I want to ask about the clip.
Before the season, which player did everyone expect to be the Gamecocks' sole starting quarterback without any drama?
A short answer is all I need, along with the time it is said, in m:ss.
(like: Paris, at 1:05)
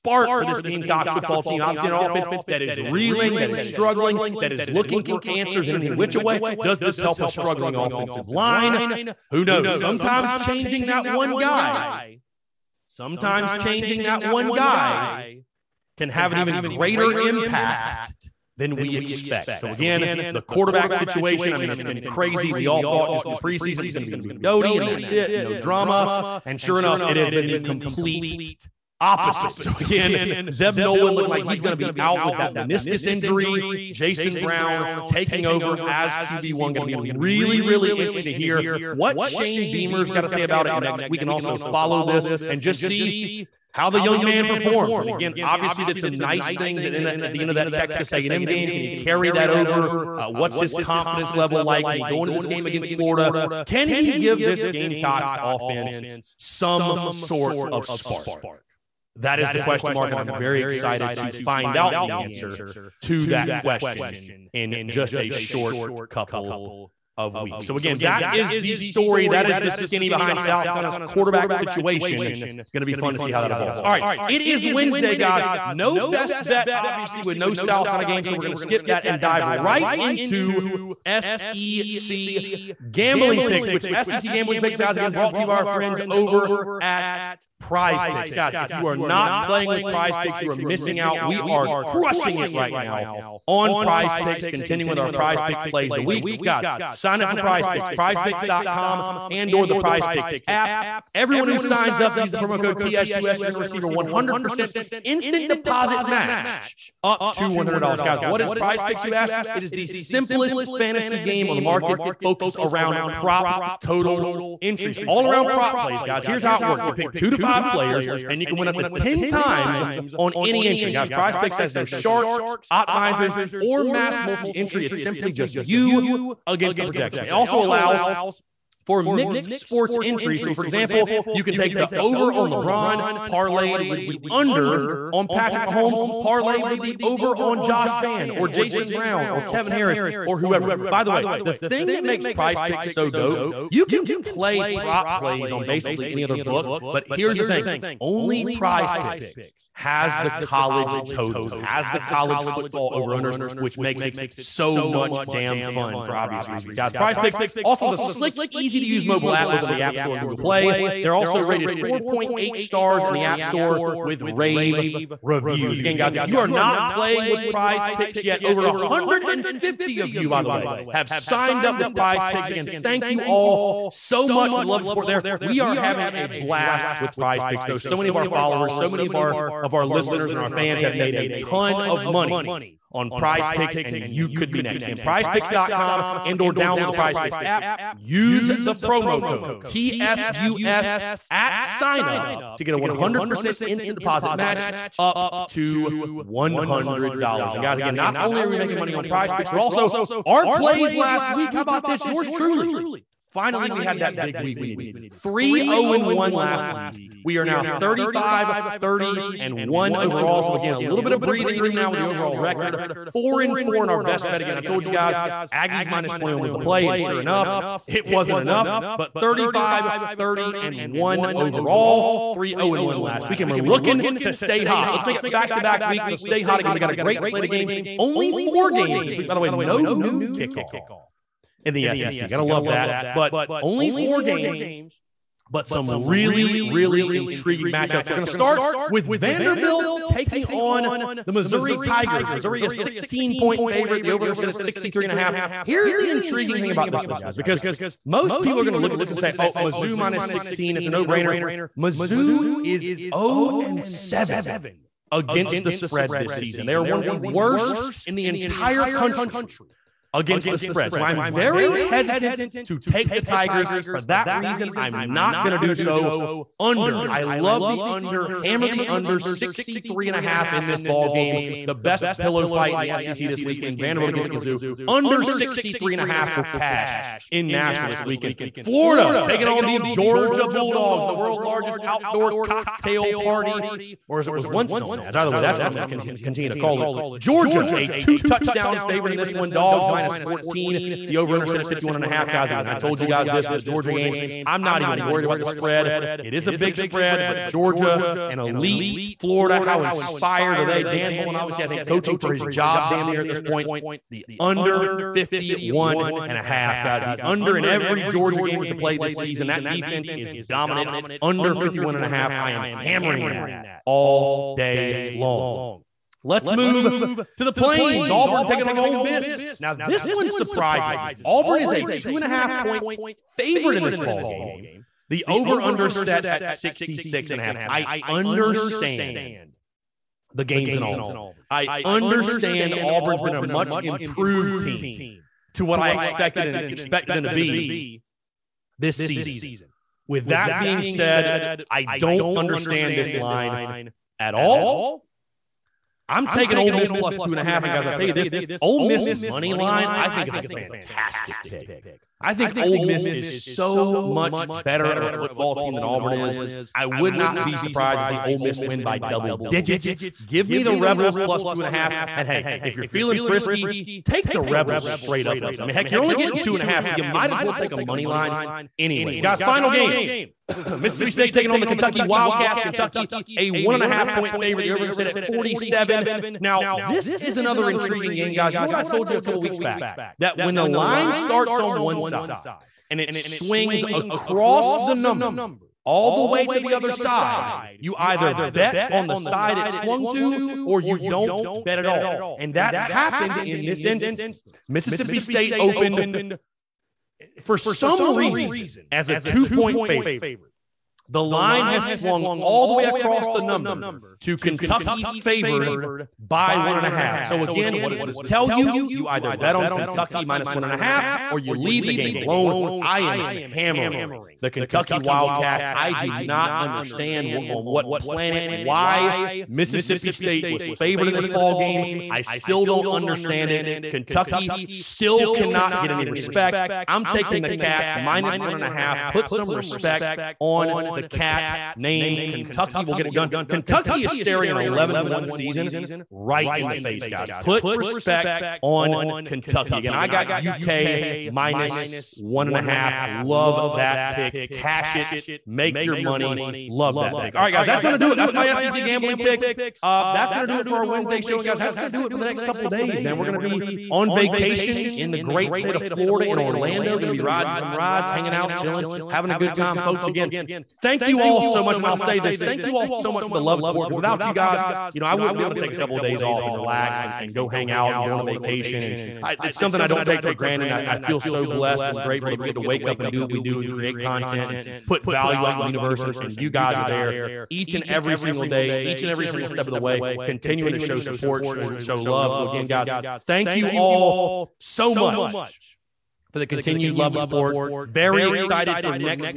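Luke Doty, at 0:24.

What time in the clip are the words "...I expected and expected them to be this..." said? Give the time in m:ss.
5:35.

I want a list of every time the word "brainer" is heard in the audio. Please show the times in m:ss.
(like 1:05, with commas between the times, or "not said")
4:11.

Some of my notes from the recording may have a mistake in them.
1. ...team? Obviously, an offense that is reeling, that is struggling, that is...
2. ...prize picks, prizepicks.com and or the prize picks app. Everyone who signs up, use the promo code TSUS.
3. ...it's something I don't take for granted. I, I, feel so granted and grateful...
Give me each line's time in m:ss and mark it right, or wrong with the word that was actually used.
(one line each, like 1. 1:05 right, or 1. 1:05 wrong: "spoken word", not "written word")
1. 0:01 right
2. 1:37 right
3. 7:49 wrong: "blessed", not "granted".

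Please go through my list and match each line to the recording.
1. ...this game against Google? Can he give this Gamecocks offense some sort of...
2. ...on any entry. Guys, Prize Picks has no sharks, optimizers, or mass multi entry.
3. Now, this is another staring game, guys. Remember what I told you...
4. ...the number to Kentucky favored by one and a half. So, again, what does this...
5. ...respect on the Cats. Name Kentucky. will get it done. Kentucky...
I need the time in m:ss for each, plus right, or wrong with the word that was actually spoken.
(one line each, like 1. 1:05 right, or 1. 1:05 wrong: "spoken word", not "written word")
1. 0:52 wrong: "Florida", not "Google"
2. 2:00 right
3. 6:16 wrong: "intriguing", not "staring"
4. 6:43 right
5. 7:09 right.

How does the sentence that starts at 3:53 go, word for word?
But only four games, but some really, really intriguing matchups.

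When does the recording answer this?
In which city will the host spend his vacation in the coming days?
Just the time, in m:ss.
7:36.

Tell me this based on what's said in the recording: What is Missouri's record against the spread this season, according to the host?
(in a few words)
0-7.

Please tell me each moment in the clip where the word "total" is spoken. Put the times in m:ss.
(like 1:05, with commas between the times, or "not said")
1:53, 2:31.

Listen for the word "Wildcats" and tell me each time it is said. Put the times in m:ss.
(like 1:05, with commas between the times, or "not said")
6:12, 6:54.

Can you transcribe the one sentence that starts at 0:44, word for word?
And again, obviously did some nice things at, at the end of that Texas A&M game.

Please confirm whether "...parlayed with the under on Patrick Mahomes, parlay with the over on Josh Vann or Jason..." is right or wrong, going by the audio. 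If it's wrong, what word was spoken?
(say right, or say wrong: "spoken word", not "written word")
right.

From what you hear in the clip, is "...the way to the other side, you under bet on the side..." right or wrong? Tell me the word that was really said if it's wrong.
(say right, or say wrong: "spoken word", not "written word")
wrong: "either", not "under".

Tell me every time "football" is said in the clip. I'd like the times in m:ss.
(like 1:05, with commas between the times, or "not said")
0:01, 2:32, 5:55.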